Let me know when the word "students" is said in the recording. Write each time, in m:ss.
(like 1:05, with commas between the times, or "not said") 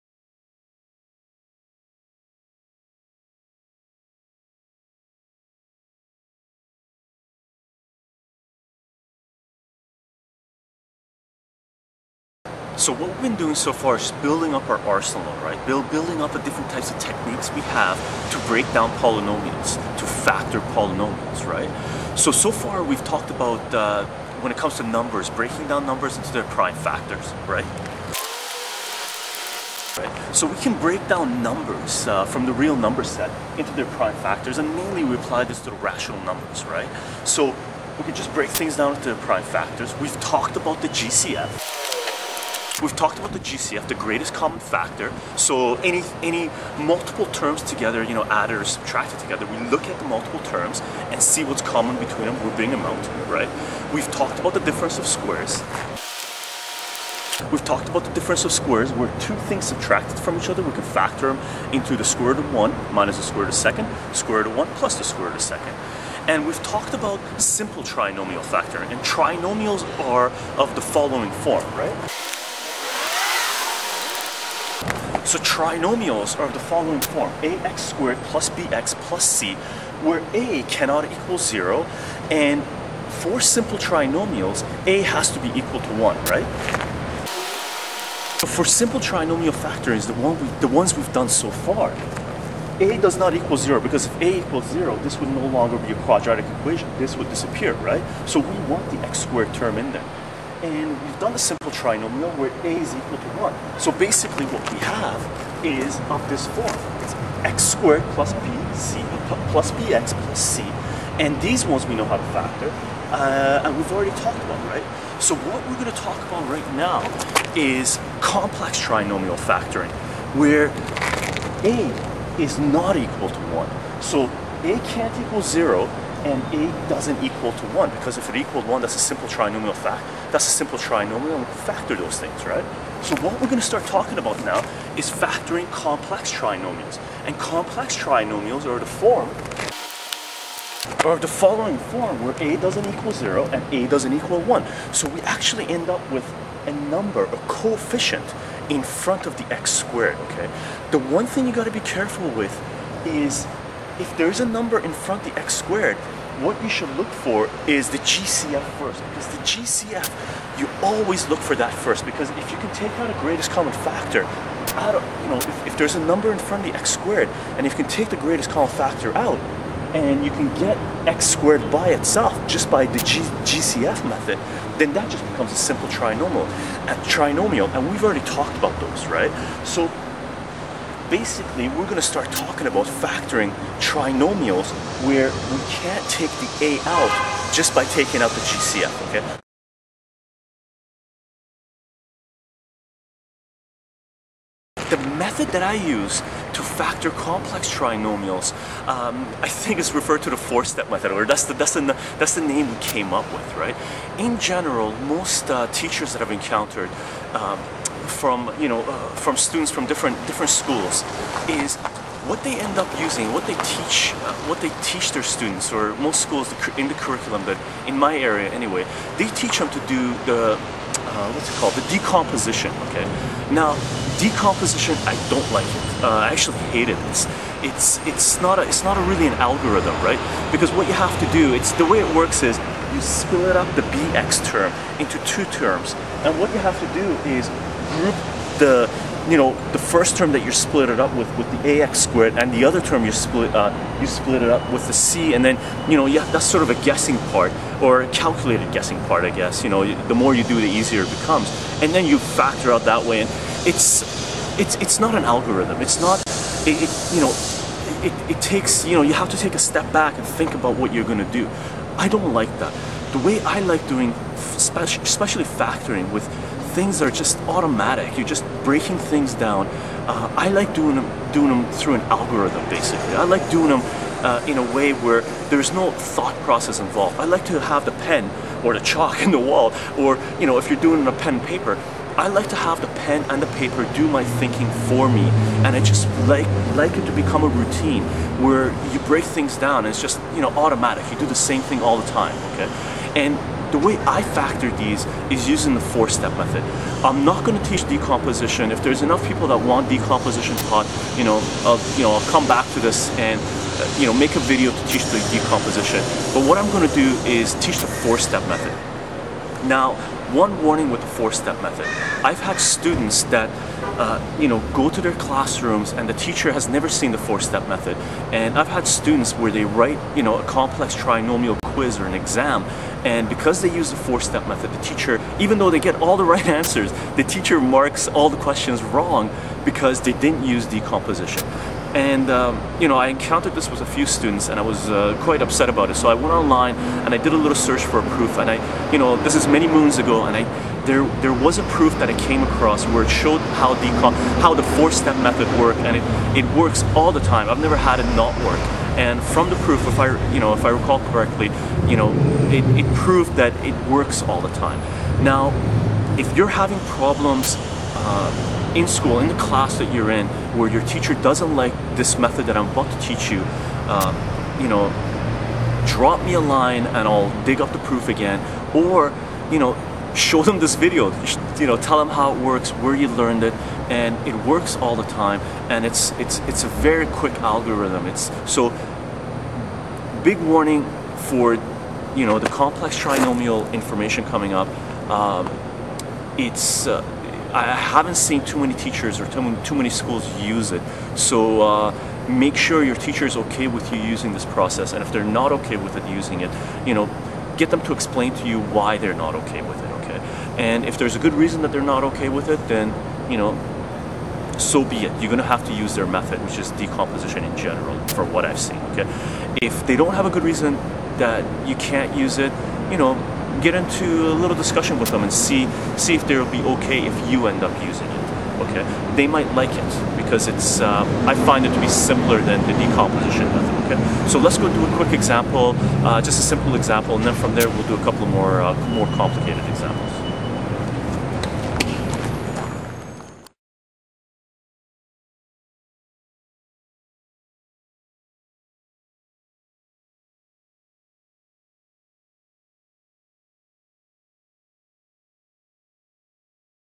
3:29, 3:35, 5:12, 5:18, 5:34.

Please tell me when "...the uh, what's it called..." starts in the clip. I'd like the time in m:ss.
3:40.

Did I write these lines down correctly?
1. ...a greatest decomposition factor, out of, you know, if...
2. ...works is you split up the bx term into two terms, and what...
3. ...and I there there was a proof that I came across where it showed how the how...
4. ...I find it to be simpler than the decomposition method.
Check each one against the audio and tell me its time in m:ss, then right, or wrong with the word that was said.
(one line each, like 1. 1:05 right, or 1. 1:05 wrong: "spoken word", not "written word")
1. 2:43 wrong: "common", not "decomposition"
2. 3:52 right
3. 5:40 right
4. 7:01 right.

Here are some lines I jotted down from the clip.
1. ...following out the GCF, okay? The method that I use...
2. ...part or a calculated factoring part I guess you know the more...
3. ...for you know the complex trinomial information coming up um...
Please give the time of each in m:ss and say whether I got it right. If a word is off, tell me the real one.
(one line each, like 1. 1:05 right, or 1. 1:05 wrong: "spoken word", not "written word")
1. 3:07 wrong: "taking", not "following"
2. 4:07 wrong: "guessing", not "factoring"
3. 6:21 right.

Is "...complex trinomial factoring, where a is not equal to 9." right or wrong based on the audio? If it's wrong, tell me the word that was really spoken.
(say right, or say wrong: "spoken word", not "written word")
wrong: "1", not "9".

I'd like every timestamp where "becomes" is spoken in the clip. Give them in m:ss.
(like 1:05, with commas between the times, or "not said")
2:55, 4:11, 4:47.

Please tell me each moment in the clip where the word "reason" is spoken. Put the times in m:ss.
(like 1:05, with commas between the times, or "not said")
6:41, 6:50.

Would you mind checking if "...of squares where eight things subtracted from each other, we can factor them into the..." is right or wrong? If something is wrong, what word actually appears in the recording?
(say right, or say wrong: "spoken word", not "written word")
wrong: "two", not "eight".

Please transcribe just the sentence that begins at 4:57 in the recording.
I'm not going to teach decomposition.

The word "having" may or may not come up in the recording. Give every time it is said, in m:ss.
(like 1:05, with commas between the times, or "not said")
5:56.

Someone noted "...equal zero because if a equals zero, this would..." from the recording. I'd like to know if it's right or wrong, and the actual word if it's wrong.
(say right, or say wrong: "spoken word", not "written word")
right.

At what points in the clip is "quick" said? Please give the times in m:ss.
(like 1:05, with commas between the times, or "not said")
6:17, 7:04.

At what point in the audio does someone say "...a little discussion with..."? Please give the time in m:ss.
6:54.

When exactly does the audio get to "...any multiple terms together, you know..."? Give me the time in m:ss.
0:46.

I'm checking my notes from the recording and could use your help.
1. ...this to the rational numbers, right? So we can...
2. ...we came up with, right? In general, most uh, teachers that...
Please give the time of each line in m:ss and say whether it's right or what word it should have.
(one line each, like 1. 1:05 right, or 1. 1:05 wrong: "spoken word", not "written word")
1. 0:35 right
2. 3:22 right.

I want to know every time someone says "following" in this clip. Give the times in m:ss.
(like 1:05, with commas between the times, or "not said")
1:10, 1:16, 2:21.